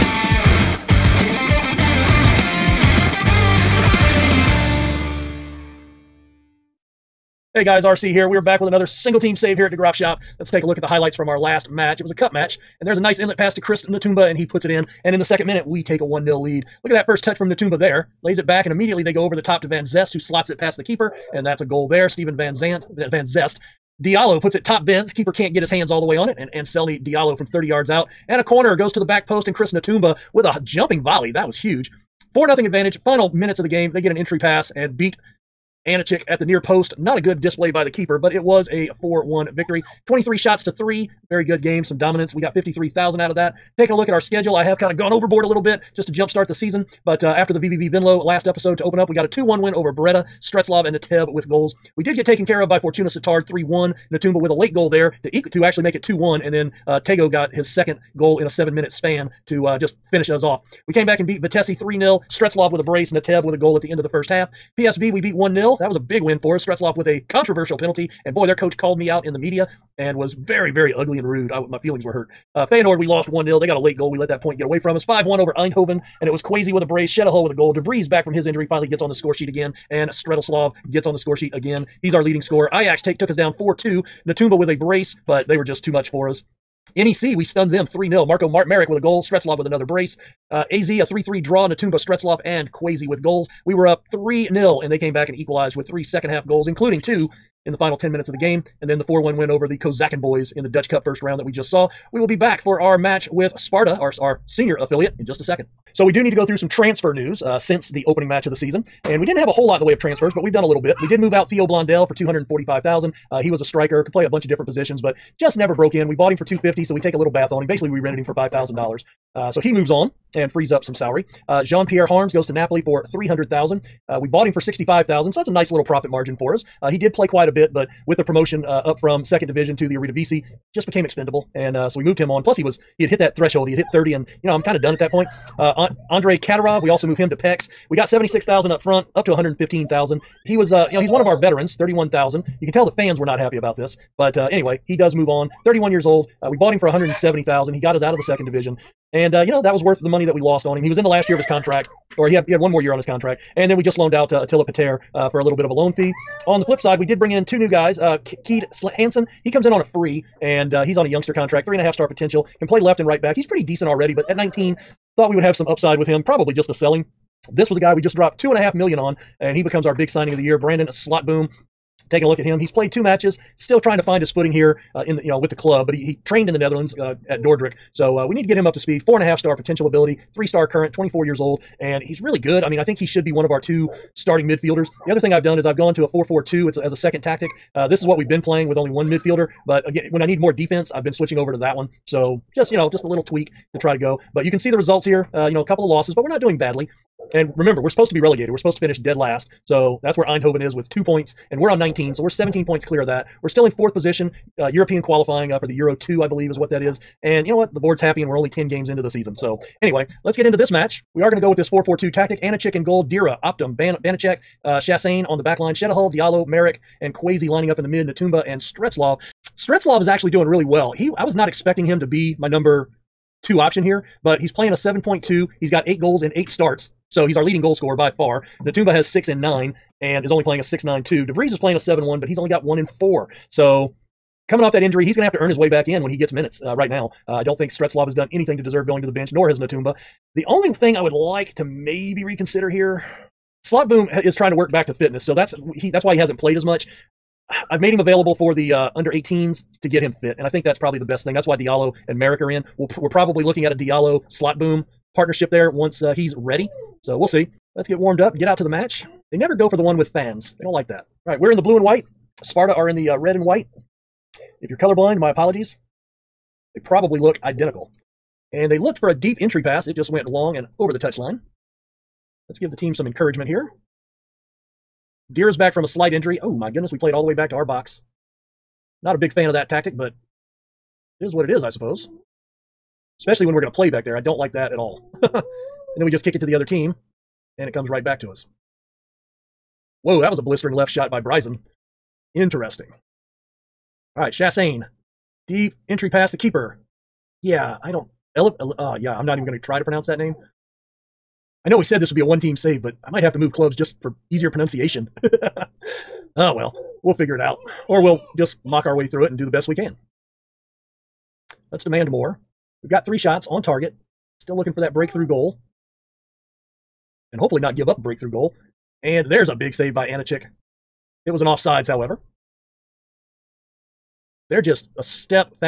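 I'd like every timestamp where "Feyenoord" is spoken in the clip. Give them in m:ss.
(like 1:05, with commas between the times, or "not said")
1:12.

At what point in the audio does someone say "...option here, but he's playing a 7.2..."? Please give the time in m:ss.
3:43.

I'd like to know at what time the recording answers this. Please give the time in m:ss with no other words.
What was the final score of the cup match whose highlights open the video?
0:39.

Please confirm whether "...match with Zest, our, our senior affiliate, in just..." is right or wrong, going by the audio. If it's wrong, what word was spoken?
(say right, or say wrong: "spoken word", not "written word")
wrong: "Sparta", not "Zest".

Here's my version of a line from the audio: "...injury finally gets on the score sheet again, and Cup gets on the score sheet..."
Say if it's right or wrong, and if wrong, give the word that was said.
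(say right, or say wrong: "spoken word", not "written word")
wrong: "Stretoslav", not "Cup".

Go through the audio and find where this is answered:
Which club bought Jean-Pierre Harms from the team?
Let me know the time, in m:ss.
2:02.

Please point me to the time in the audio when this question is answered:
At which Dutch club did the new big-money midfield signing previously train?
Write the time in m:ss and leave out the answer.
2:57.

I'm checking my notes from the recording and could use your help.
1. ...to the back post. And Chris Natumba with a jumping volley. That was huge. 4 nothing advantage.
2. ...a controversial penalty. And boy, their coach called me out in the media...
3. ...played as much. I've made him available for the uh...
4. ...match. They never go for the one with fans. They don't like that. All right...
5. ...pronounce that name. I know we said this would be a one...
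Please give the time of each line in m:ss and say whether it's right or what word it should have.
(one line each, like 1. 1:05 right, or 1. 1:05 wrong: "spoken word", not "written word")
1. 0:28 right
2. 1:07 right
3. 4:06 right
4. 4:18 right
5. 4:59 right.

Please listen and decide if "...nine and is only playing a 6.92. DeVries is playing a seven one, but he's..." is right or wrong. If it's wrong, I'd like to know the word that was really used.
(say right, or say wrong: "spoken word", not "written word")
right.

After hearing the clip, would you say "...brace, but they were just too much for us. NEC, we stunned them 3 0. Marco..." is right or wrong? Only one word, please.
right.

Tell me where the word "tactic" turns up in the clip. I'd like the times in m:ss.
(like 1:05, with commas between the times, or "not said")
3:07, 3:32, 4:39.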